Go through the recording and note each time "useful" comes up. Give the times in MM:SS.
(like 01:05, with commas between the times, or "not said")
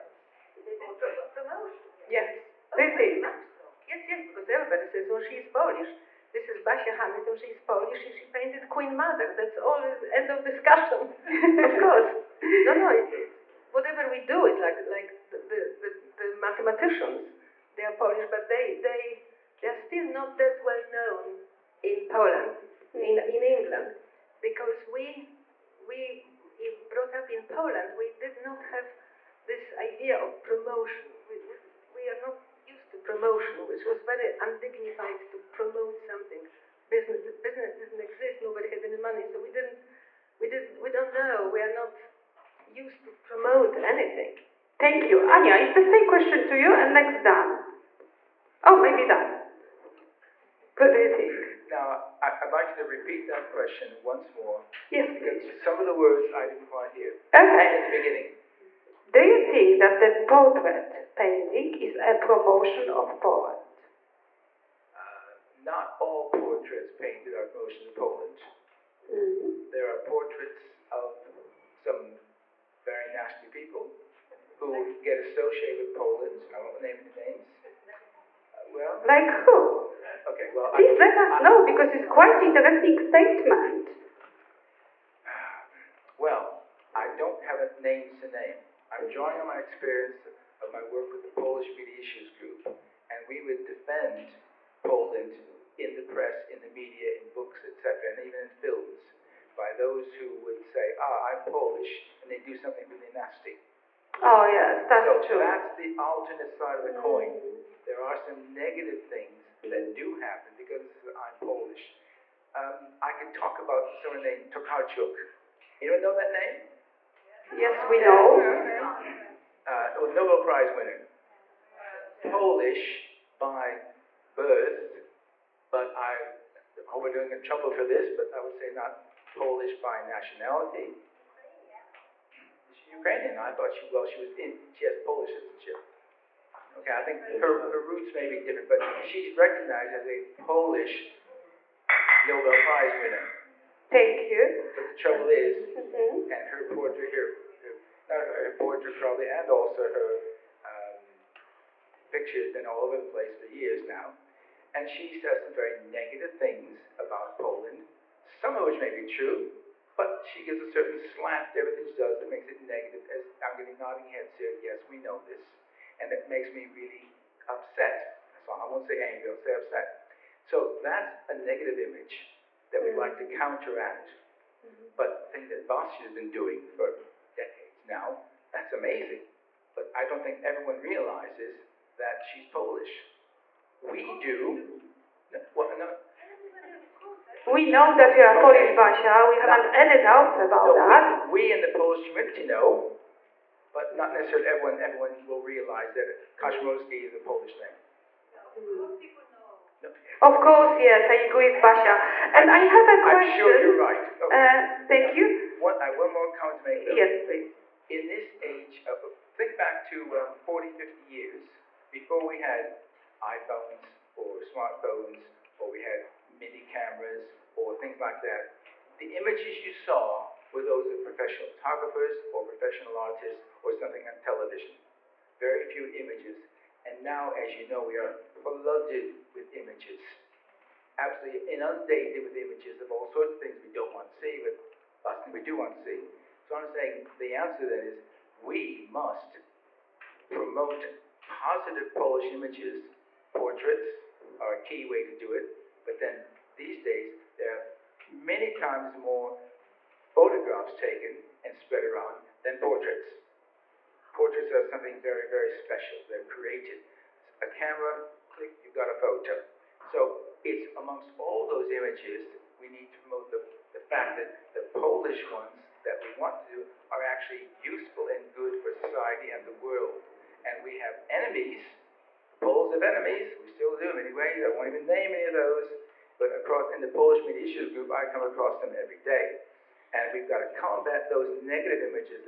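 04:27.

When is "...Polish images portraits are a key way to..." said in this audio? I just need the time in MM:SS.
04:01.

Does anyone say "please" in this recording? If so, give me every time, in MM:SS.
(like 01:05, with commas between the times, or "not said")
00:55, 01:20, 03:27.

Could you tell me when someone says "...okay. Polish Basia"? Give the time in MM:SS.
03:08.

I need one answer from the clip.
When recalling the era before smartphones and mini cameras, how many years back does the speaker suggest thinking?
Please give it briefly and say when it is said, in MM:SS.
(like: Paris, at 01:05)
40 to 50 years, at 03:30.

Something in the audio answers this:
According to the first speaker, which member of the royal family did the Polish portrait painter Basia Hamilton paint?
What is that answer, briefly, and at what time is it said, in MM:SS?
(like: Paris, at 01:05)
Queen Mother, at 00:08.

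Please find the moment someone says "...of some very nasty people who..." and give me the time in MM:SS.
01:10.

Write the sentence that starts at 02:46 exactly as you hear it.
And it makes me really upset.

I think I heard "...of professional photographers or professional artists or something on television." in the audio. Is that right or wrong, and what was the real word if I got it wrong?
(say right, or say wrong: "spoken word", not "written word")
right.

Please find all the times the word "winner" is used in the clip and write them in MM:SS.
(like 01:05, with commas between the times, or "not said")
02:00, 02:23.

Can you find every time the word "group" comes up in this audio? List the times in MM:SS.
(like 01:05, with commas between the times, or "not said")
01:32, 04:37.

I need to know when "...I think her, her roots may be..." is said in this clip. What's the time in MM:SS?
02:16.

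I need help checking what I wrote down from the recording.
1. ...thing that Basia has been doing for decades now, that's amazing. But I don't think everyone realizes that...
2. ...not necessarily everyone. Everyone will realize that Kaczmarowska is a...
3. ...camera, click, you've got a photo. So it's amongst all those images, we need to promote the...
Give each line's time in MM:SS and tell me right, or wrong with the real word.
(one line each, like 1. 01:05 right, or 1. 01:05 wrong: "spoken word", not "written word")
1. 02:55 right
2. 03:13 right
3. 04:17 right.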